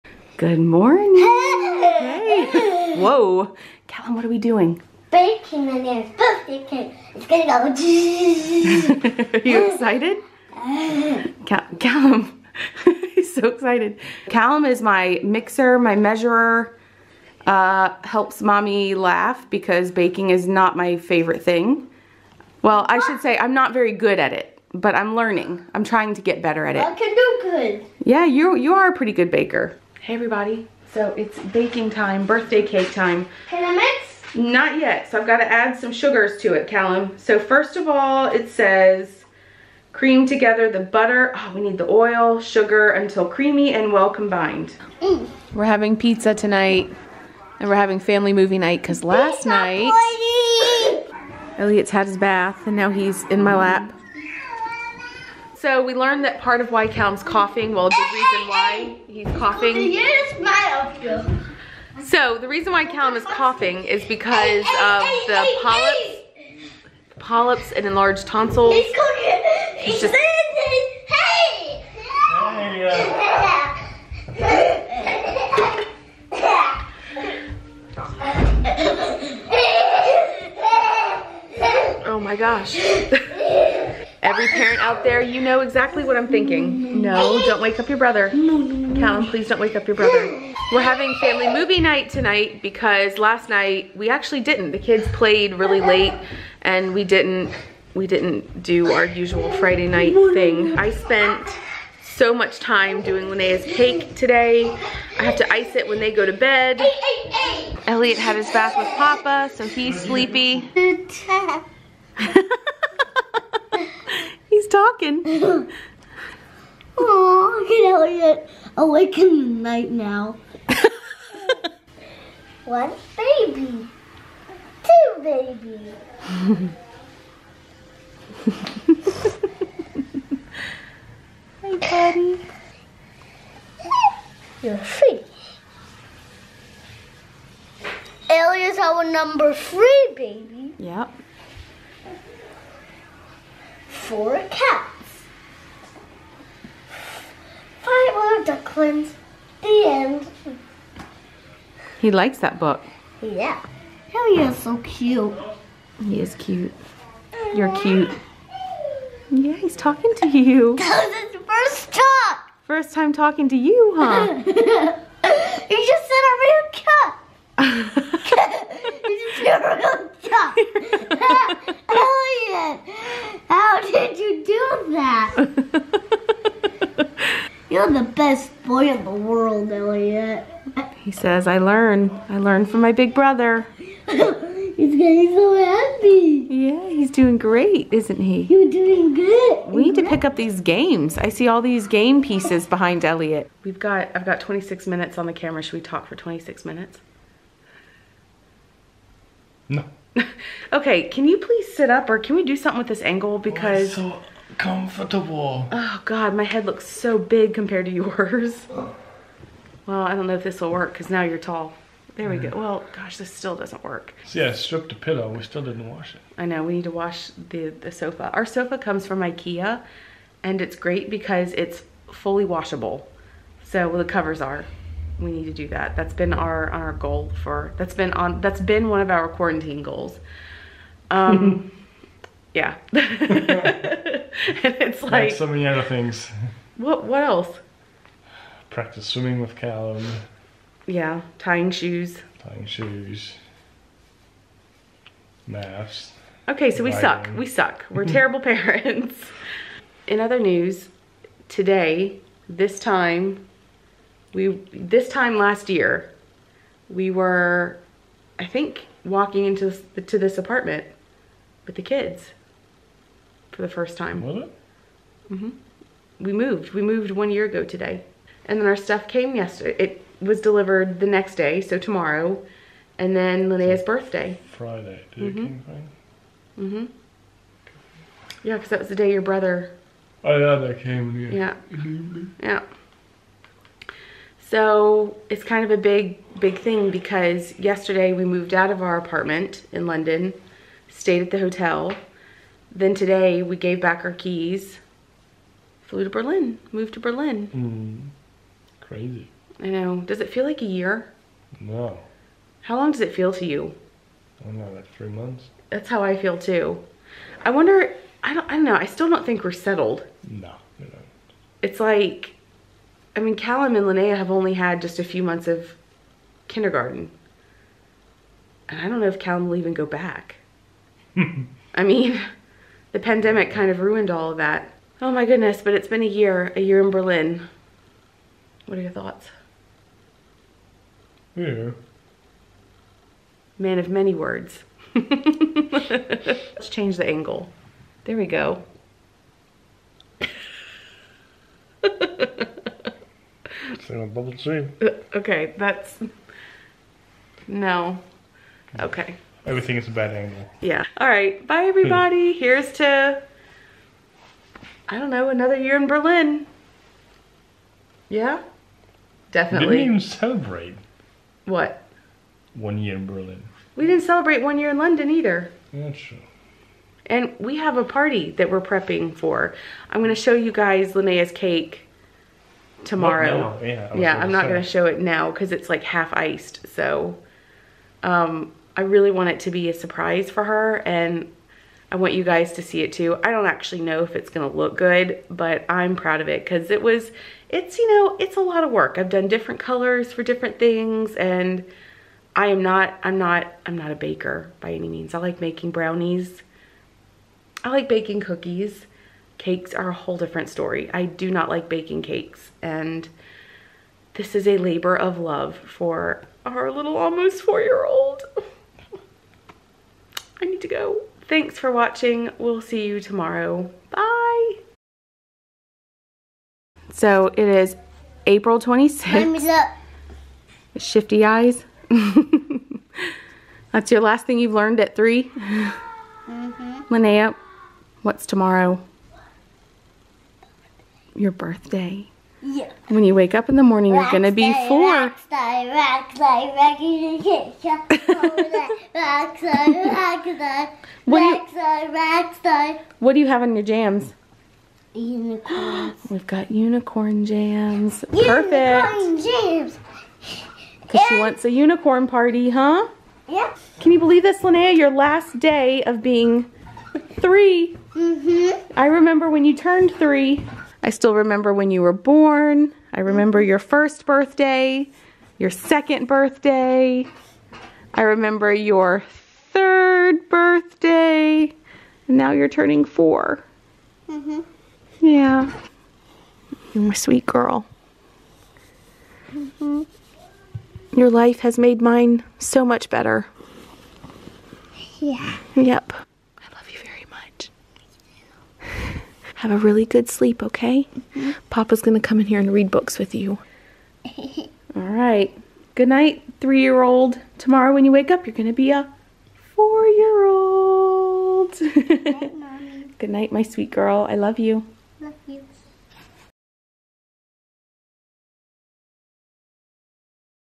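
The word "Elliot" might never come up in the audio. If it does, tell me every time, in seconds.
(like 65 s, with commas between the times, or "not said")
51 s, 107 s, 117 s, 138 s, 170 s, 179 s, 193 s.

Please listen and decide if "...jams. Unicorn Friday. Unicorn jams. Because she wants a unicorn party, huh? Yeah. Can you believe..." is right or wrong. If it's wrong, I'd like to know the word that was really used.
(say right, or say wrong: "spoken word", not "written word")
wrong: "Perfect", not "Friday".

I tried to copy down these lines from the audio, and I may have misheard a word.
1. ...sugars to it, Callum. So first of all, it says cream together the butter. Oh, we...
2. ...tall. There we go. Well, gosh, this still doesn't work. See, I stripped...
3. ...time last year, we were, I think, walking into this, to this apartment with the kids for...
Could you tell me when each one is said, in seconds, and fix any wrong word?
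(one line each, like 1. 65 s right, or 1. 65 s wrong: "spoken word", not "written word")
1. 35 s right
2. 211 s right
3. 255 s right.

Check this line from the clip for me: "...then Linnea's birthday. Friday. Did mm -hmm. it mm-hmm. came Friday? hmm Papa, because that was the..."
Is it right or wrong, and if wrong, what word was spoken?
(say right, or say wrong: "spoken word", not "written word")
wrong: "Yeah", not "Papa".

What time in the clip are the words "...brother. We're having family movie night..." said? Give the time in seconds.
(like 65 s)
89 s.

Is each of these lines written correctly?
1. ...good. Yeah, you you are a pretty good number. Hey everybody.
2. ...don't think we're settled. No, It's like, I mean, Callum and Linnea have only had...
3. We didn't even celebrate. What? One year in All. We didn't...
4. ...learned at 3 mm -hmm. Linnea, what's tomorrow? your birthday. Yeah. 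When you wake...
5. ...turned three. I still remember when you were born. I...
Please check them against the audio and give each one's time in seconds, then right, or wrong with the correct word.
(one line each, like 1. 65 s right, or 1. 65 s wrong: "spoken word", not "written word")
1. 27 s wrong: "baker", not "number"
2. 309 s right
3. 359 s wrong: "Berlin", not "All"
4. 424 s right
5. 459 s right.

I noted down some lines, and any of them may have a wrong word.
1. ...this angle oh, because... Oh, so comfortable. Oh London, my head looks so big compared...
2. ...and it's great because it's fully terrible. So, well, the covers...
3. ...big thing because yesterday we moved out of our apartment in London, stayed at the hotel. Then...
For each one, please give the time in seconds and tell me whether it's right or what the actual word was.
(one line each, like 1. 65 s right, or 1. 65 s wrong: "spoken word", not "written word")
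1. 202 s wrong: "God", not "London"
2. 220 s wrong: "washable", not "terrible"
3. 286 s right.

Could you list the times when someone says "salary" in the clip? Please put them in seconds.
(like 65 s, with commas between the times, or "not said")
not said.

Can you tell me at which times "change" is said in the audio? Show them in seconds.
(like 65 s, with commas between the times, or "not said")
336 s.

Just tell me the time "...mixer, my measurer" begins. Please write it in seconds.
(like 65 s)
15 s.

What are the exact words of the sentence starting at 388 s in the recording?
I've done different colors for different things and I am not, I'm not, I'm not a baker by any means.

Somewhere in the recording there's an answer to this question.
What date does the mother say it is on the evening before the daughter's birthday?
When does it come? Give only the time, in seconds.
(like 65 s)
418 s.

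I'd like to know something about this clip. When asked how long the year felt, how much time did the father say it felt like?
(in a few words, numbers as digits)
3 months.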